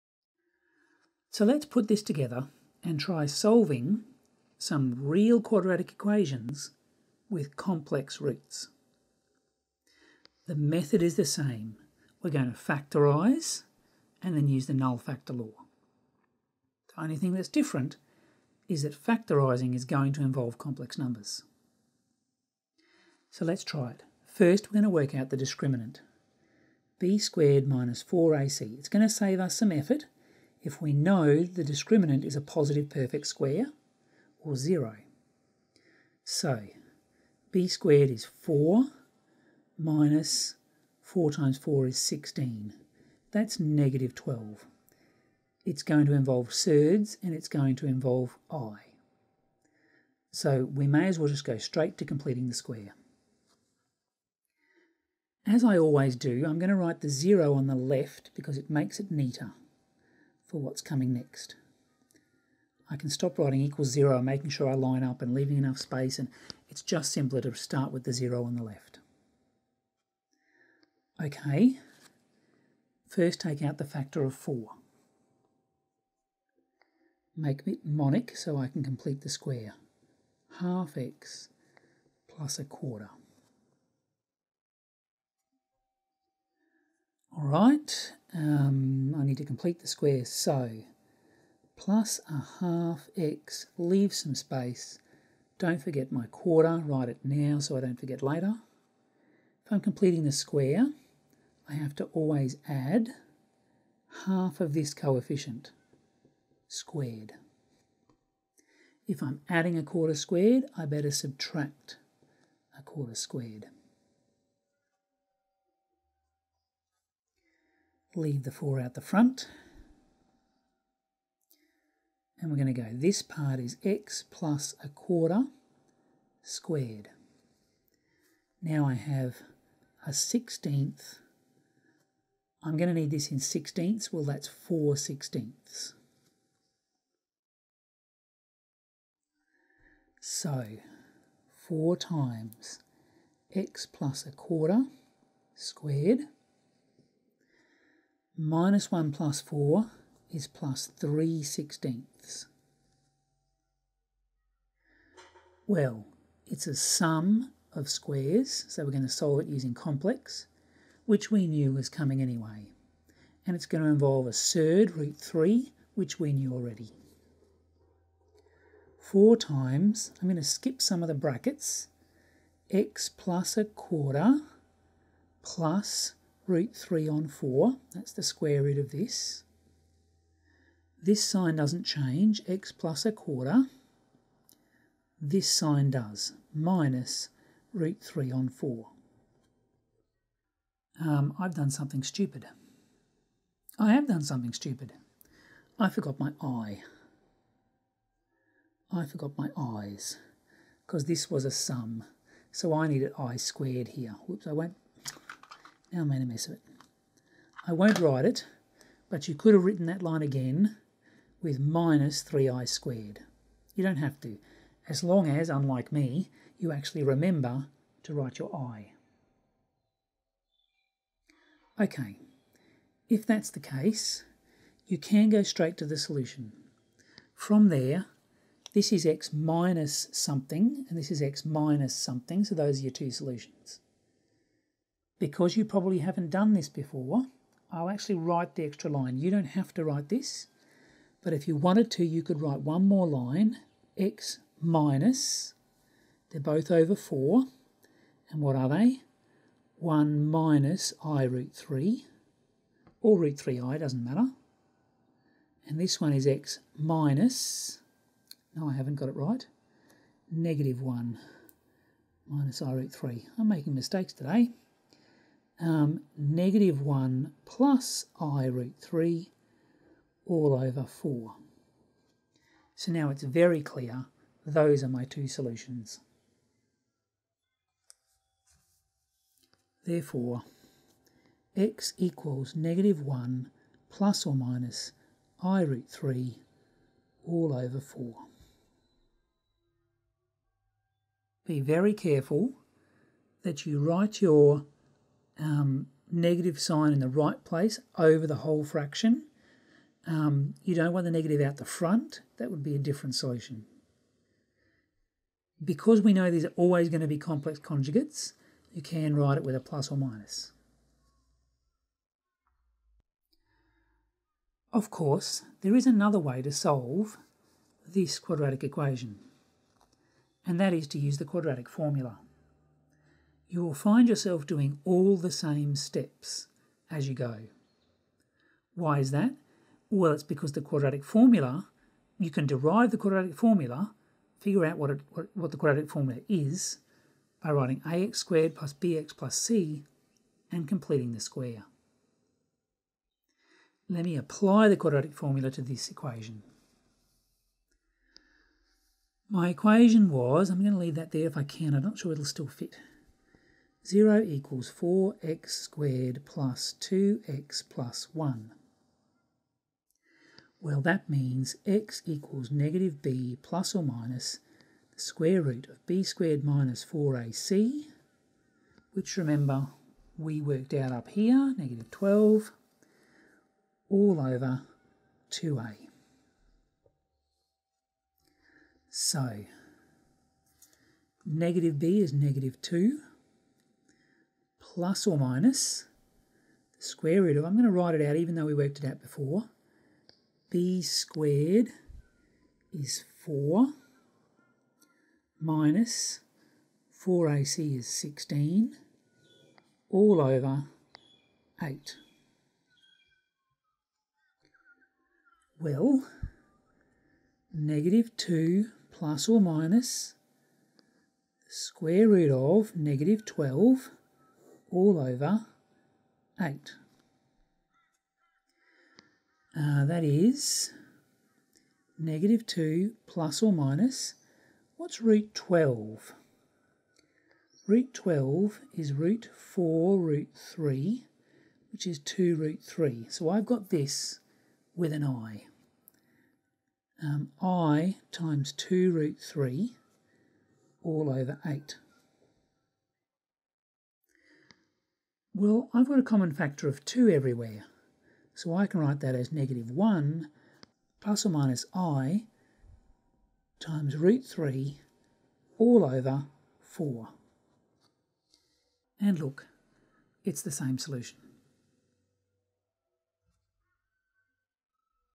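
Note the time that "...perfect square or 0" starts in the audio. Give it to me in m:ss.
0:32.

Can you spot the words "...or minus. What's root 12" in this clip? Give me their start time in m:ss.
7:03.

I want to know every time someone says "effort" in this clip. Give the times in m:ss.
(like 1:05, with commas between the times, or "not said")
0:29.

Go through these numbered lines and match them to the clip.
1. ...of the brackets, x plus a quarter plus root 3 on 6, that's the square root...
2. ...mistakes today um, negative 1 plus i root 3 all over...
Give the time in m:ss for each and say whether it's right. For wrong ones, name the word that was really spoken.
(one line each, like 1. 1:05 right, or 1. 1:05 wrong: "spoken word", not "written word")
1. 2:51 wrong: "4", not "6"
2. 4:23 right.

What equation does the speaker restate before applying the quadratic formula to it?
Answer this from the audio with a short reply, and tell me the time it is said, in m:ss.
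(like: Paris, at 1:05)
0 = 4x² + 2x + 1, at 5:53.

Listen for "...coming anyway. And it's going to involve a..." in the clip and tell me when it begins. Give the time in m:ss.
2:41.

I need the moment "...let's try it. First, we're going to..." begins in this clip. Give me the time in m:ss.
0:23.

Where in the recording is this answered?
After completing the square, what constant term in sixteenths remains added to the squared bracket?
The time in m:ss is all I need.
2:30.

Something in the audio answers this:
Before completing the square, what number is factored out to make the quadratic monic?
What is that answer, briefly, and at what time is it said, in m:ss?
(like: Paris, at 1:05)
4, at 1:13.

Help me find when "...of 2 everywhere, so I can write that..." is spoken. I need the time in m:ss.
7:26.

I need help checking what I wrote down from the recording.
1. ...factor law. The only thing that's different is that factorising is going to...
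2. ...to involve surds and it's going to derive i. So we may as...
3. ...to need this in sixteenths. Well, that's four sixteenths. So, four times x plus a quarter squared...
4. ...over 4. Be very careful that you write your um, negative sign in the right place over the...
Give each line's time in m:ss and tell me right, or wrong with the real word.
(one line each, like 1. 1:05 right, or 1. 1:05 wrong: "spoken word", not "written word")
1. 0:14 right
2. 0:46 wrong: "involve", not "derive"
3. 2:12 right
4. 4:47 right.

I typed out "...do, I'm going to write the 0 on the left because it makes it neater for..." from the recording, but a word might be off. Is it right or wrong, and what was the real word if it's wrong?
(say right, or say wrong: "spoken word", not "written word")
right.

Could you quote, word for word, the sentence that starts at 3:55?
Because you probably haven't done this before, I'll actually write the extra line.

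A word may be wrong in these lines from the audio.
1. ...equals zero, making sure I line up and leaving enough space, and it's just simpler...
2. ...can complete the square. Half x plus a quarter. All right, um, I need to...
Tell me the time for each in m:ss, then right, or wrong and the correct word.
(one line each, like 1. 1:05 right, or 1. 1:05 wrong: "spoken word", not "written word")
1. 1:03 right
2. 1:18 right.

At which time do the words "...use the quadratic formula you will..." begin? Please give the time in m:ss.
5:20.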